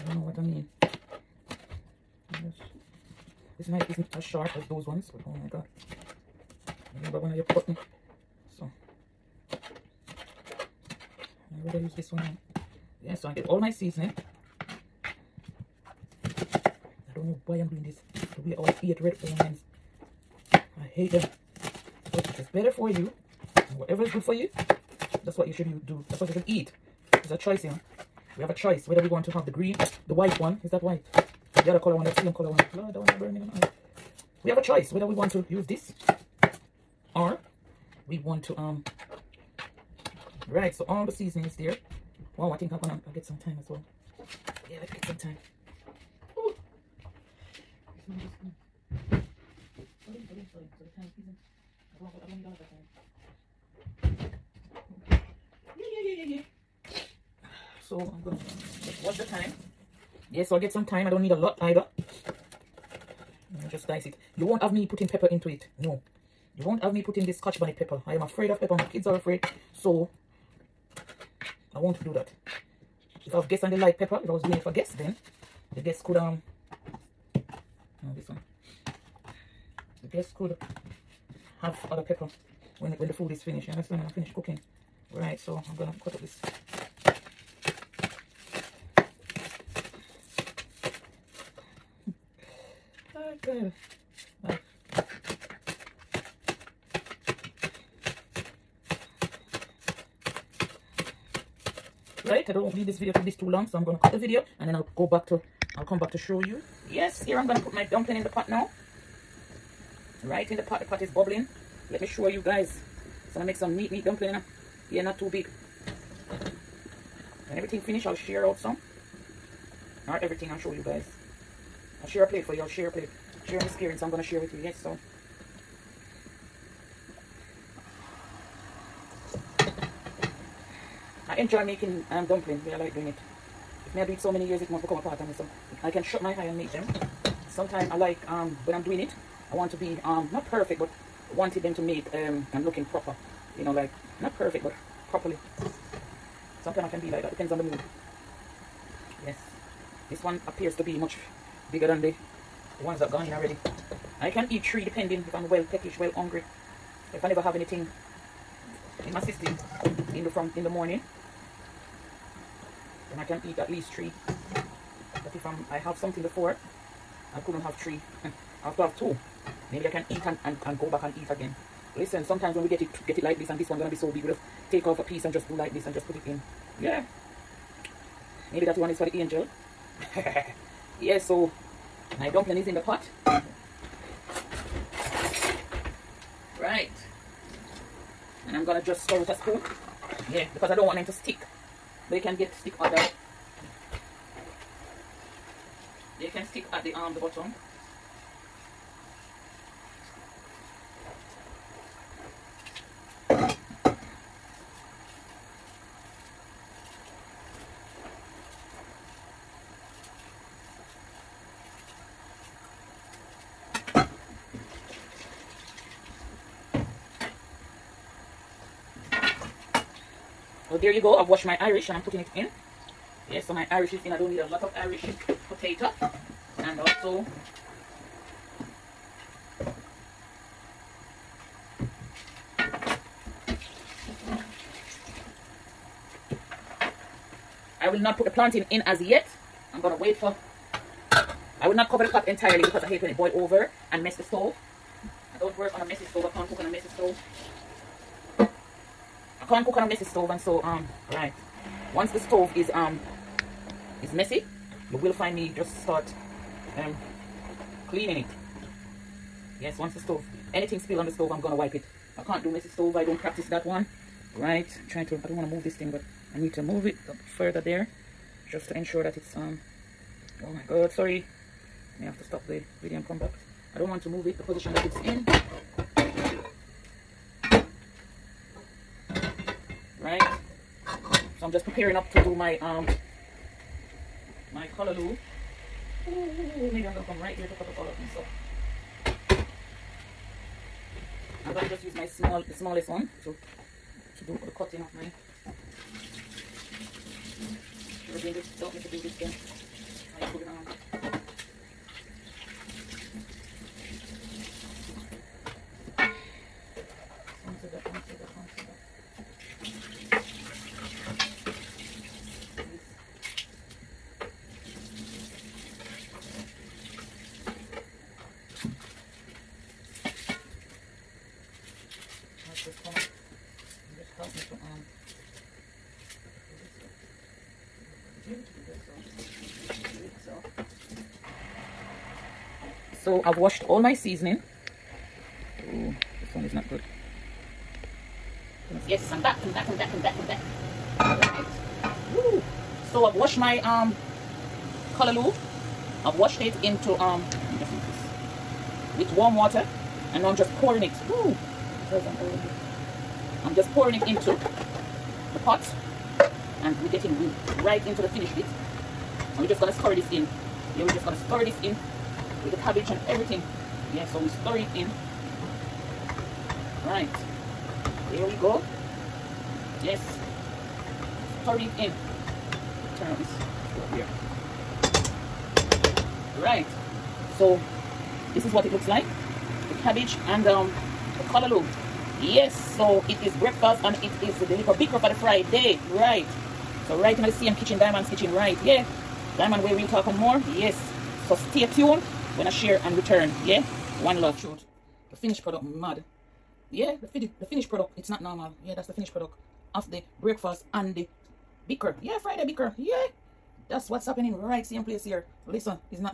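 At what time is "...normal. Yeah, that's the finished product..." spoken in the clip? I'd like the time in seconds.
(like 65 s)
398 s.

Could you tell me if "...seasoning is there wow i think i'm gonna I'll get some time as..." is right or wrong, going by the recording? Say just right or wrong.
right.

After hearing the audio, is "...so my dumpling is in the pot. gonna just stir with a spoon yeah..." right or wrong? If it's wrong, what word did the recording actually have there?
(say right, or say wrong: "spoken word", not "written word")
right.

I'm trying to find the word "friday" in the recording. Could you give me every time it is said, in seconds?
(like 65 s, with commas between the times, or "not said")
385 s, 402 s.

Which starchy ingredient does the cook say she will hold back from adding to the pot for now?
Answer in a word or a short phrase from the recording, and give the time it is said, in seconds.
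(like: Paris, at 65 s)
Plantain, at 238 s.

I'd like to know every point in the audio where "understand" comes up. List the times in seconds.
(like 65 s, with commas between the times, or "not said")
83 s.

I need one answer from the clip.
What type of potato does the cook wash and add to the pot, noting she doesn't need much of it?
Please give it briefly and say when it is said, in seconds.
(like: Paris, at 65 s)
Irish potato, at 224 s.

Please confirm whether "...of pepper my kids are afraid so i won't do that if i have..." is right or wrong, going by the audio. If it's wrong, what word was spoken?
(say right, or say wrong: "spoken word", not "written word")
right.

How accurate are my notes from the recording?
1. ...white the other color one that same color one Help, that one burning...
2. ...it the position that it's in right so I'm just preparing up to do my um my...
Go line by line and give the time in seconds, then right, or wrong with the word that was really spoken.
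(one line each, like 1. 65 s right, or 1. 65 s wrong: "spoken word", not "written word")
1. 30 s wrong: "Lord", not "Help"
2. 274 s right.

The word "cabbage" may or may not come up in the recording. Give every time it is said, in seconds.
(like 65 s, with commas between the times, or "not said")
362 s, 379 s.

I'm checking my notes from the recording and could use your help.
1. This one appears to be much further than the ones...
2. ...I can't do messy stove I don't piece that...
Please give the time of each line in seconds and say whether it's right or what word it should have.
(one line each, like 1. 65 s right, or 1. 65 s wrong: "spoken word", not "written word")
1. 150 s wrong: "bigger", not "further"
2. 262 s wrong: "practice", not "piece".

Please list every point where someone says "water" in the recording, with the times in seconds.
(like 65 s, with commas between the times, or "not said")
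349 s.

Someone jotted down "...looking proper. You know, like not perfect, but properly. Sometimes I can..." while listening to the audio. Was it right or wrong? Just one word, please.
right.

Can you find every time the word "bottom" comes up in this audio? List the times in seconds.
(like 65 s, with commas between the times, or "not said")
197 s.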